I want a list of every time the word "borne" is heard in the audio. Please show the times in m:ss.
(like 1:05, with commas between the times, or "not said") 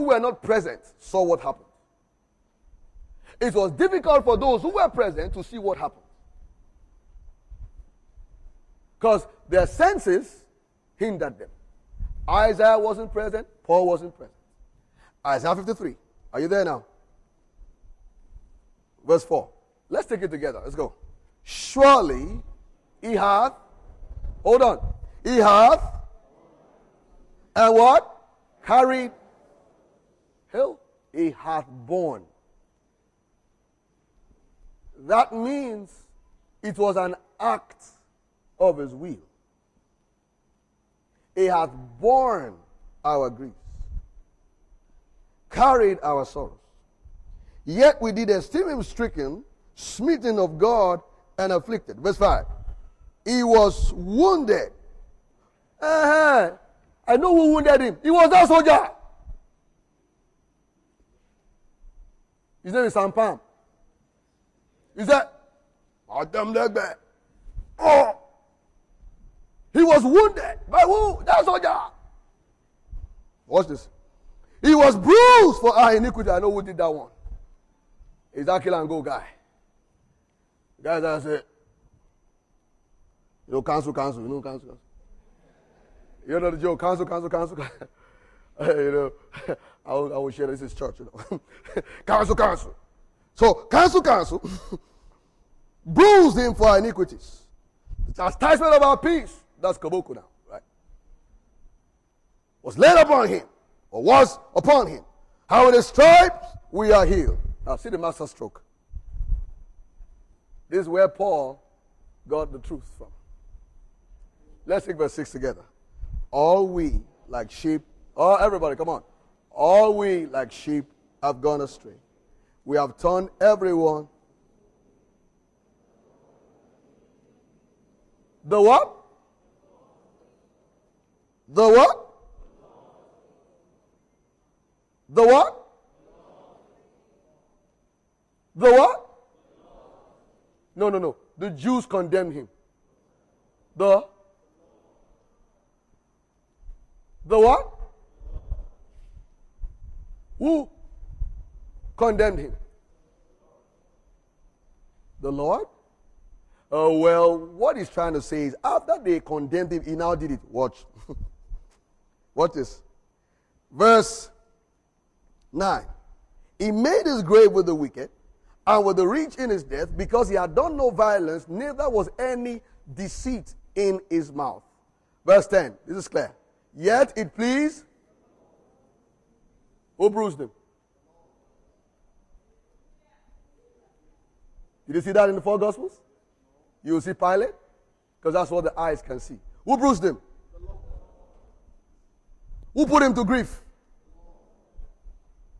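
0:31, 0:41.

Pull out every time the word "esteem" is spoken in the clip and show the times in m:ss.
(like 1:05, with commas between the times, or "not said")
0:48.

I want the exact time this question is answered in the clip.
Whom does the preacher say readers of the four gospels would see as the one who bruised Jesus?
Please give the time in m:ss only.
3:07.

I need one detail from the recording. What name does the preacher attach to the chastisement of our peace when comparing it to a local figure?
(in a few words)
Kabuku.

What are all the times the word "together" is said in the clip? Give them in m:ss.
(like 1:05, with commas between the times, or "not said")
0:20, 1:55.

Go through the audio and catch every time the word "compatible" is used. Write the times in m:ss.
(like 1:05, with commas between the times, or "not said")
not said.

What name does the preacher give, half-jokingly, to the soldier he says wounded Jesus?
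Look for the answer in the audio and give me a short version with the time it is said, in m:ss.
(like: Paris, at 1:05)
Sampam, at 1:02.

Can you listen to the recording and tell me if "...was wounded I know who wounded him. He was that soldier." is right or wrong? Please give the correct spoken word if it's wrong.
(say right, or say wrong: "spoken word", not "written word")
right.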